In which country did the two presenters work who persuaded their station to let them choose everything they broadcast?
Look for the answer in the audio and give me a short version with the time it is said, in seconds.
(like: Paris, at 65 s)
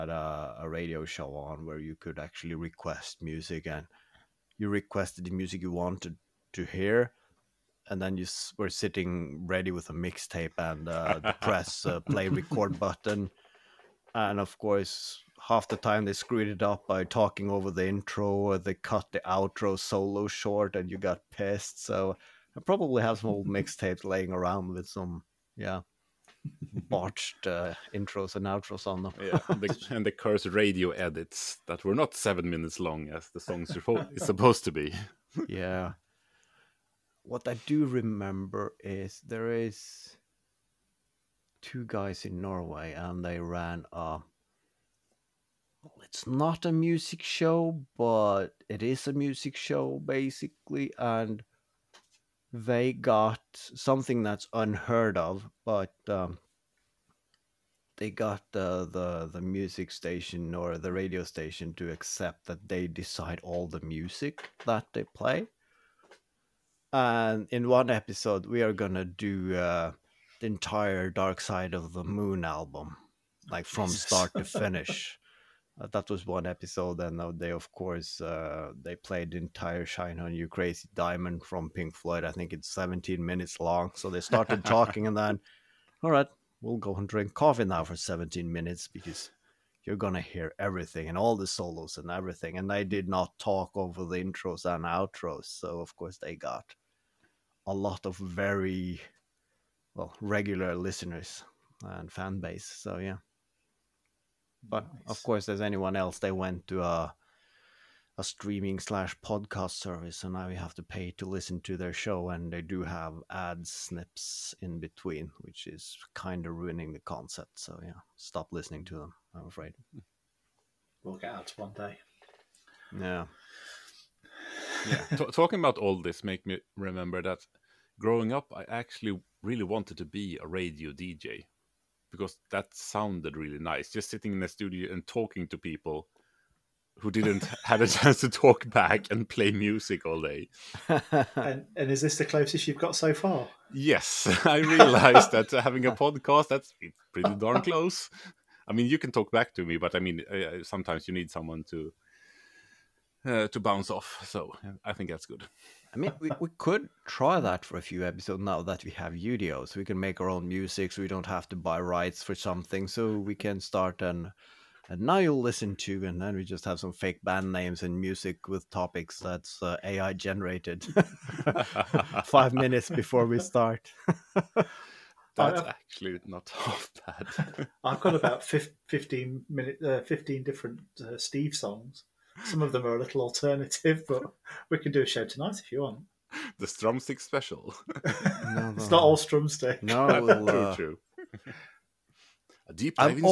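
Norway, at 42 s.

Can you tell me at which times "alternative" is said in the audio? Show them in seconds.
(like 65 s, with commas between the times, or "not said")
183 s.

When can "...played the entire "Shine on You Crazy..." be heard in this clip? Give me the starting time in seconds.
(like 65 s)
78 s.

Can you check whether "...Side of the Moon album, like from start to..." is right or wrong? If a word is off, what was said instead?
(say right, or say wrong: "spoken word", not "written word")
right.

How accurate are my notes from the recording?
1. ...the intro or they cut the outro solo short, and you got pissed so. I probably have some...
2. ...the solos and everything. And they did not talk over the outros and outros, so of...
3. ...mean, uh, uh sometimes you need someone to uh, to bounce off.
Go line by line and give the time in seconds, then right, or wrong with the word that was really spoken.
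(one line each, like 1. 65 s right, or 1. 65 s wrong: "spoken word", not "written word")
1. 17 s right
2. 91 s wrong: "intros", not "outros"
3. 149 s right.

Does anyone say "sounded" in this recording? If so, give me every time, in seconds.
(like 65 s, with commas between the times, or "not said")
132 s.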